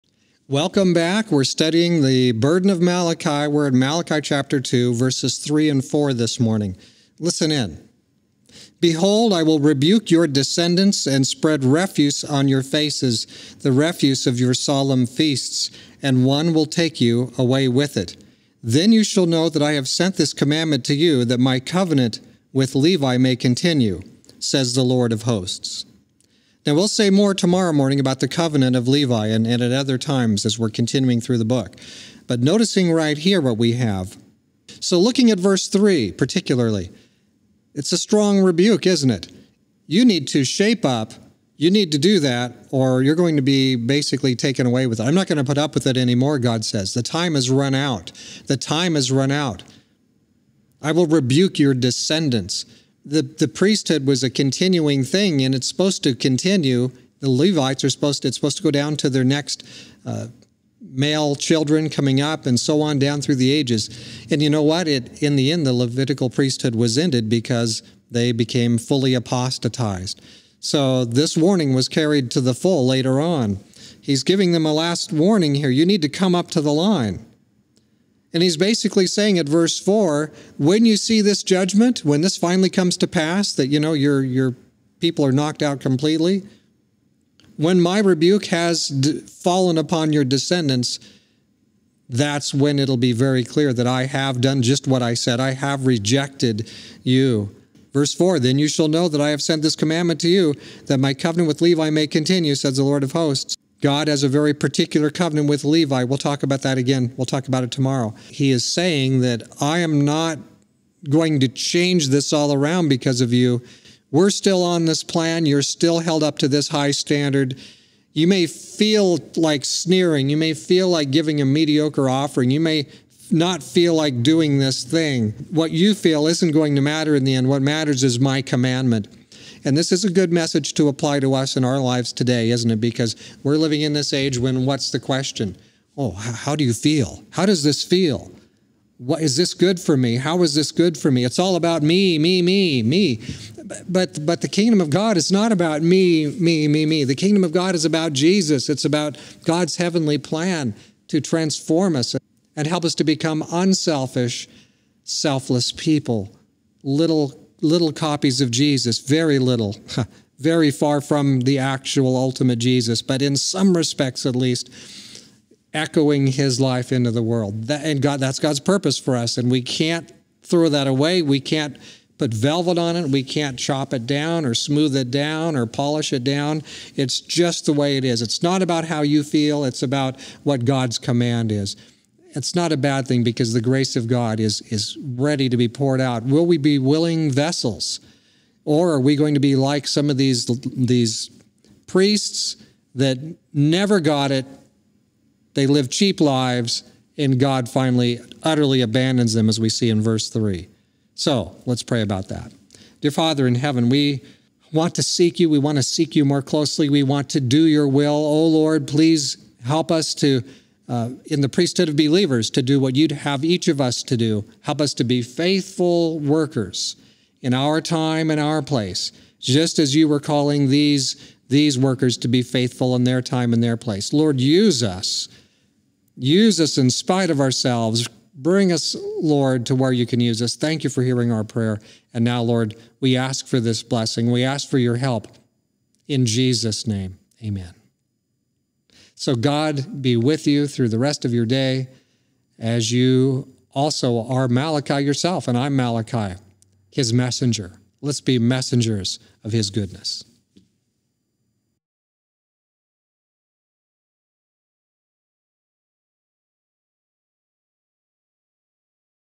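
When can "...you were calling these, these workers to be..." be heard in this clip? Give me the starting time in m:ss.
3:39.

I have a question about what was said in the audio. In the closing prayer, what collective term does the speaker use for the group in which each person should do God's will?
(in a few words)
Priesthood of believers.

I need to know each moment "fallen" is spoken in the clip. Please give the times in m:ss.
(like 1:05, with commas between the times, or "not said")
1:29.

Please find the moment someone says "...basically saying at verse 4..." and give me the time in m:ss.
1:18.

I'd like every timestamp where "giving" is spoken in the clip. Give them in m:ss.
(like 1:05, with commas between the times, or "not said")
1:14, 2:01.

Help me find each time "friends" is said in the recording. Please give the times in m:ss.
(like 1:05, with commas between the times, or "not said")
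not said.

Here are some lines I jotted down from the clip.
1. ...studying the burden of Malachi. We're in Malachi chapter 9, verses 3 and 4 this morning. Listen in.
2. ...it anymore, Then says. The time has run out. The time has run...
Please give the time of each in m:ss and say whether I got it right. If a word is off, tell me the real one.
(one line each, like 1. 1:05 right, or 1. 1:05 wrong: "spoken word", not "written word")
1. 0:01 wrong: "2", not "9"
2. 0:45 wrong: "God", not "Then".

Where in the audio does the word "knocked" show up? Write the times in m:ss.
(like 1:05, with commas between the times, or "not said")
1:25.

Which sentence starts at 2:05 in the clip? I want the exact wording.
What you feel isn't going to matter in the end.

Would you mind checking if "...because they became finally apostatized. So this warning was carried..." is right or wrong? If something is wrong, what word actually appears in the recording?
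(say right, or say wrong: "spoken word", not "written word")
wrong: "fully", not "finally".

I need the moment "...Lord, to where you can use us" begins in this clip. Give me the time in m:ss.
3:49.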